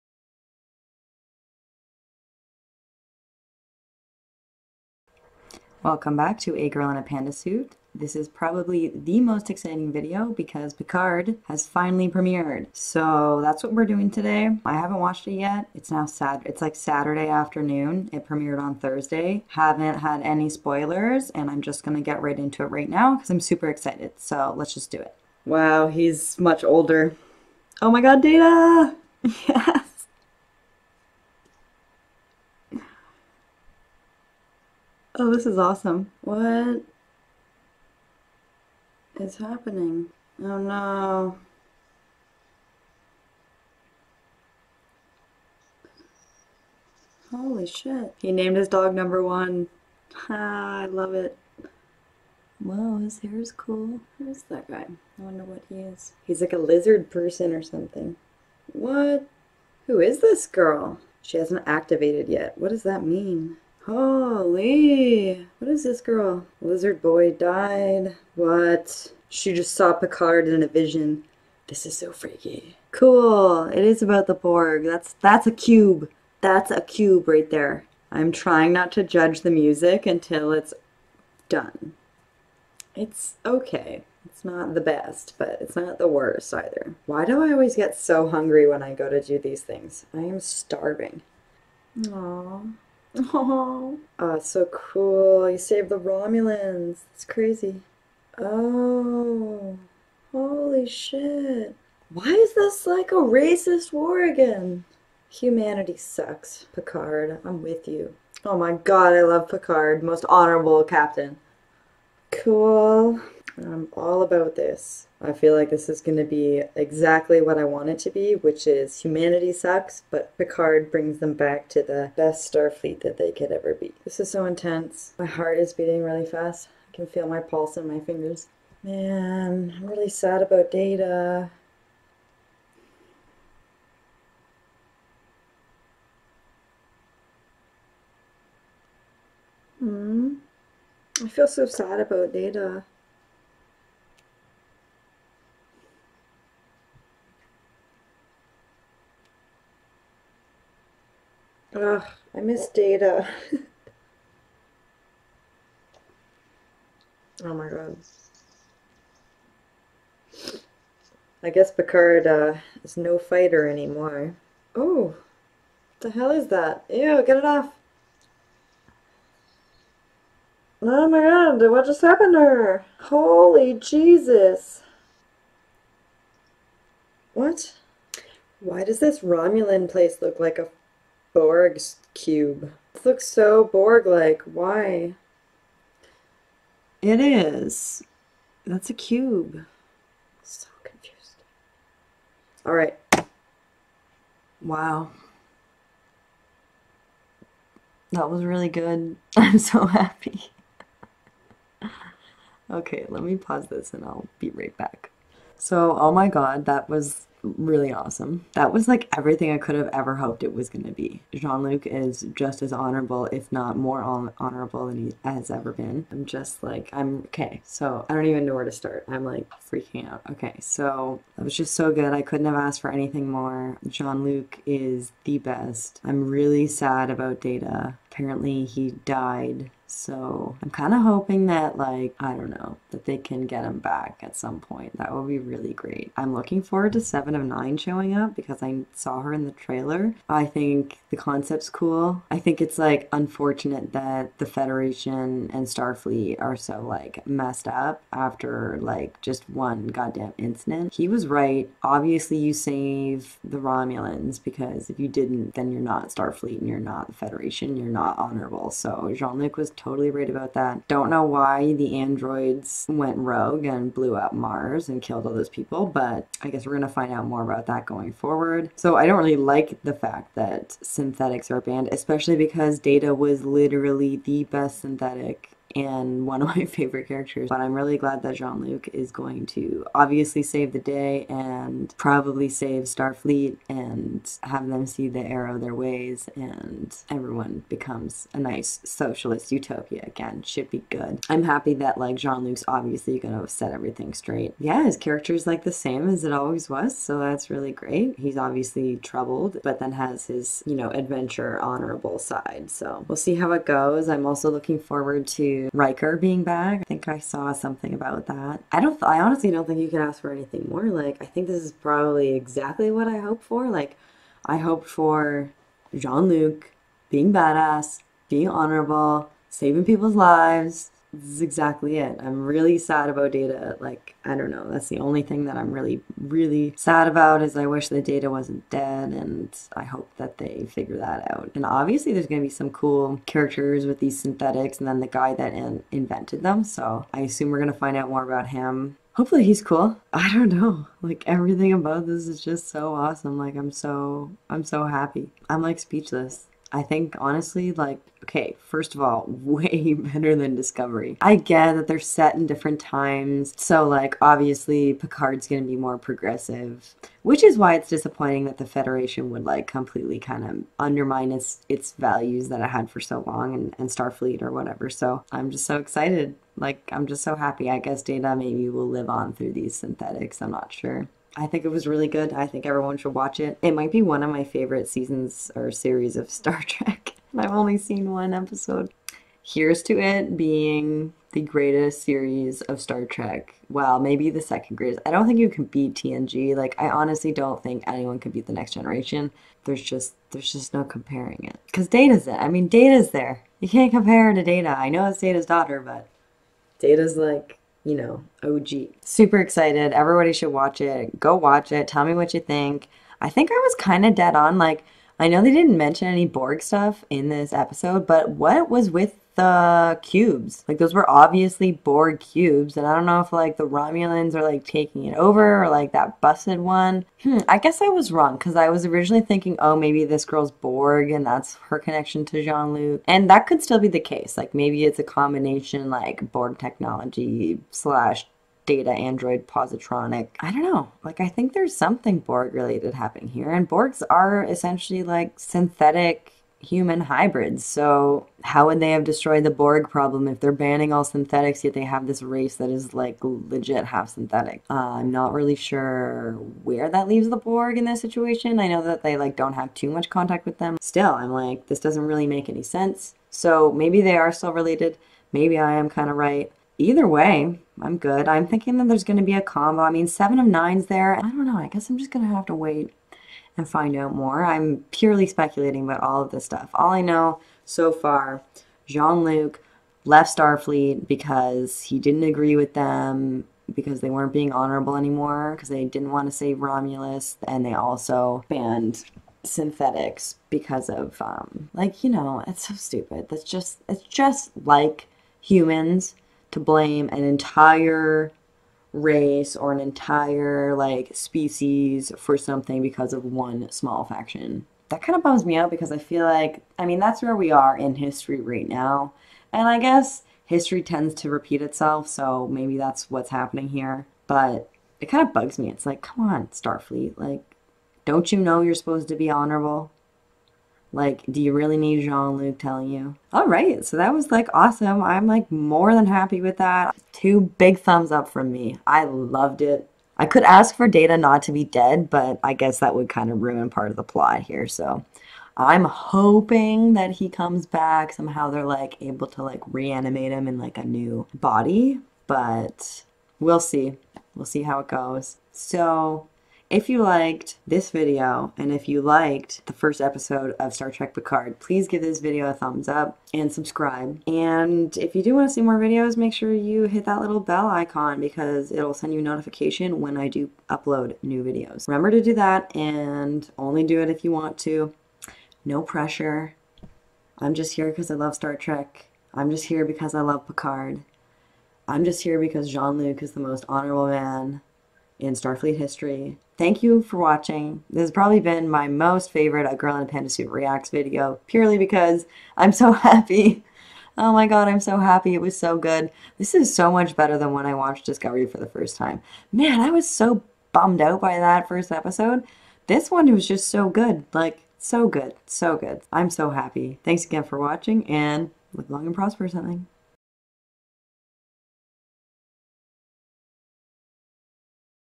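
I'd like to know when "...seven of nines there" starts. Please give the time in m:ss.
7:40.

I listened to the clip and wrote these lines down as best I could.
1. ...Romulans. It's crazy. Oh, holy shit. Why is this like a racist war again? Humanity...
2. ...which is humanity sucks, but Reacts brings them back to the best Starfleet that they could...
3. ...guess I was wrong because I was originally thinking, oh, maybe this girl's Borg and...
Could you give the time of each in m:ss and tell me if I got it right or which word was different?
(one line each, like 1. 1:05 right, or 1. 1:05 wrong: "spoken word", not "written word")
1. 1:35 right
2. 1:58 wrong: "Picard", not "Reacts"
3. 6:57 right.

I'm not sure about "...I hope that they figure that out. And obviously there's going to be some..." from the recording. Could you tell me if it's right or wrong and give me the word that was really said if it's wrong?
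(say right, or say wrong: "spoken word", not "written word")
right.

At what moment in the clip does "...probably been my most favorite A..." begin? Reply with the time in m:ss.
9:28.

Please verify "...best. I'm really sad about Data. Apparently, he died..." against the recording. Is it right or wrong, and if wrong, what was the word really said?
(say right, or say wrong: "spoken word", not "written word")
right.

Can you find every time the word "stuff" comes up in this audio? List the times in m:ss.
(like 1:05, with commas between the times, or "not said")
6:46, 7:46.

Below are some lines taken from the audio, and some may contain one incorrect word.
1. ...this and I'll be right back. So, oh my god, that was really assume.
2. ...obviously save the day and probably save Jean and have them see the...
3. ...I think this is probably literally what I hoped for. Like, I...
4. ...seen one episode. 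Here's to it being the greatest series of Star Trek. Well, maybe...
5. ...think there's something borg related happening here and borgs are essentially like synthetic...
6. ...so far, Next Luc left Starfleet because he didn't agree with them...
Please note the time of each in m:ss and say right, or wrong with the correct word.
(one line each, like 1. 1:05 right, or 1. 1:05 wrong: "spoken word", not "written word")
1. 3:23 wrong: "awesome", not "assume"
2. 4:39 wrong: "Starfleet", not "Jean"
3. 5:11 wrong: "exactly", not "literally"
4. 6:17 right
5. 7:11 right
6. 7:47 wrong: "Jean", not "Next".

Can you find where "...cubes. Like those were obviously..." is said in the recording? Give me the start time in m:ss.
6:50.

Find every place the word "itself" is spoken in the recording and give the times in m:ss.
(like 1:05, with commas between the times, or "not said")
8:21.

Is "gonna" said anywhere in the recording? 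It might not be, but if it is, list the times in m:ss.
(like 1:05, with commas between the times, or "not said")
4:53, 5:55.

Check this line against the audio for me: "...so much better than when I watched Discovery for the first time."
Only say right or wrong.
right.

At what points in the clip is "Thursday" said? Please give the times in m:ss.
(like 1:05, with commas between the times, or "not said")
0:18.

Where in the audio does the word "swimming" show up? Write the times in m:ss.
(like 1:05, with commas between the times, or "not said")
not said.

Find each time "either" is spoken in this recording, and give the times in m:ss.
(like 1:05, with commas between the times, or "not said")
1:26, 7:36.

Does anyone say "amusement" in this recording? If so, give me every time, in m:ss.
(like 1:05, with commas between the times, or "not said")
not said.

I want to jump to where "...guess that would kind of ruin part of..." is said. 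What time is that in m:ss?
8:42.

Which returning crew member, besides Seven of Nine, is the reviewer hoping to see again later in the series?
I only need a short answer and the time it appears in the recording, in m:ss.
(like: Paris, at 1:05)
Riker, at 5:05.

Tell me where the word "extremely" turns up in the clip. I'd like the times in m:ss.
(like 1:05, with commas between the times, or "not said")
not said.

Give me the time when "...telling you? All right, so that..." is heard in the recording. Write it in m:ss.
8:32.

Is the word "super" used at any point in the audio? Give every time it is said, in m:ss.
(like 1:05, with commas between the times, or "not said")
0:23, 6:39.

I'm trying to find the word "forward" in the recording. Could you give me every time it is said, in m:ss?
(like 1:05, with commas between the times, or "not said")
3:56, 4:28, 5:04.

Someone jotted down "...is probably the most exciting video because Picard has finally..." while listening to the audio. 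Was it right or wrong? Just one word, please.
right.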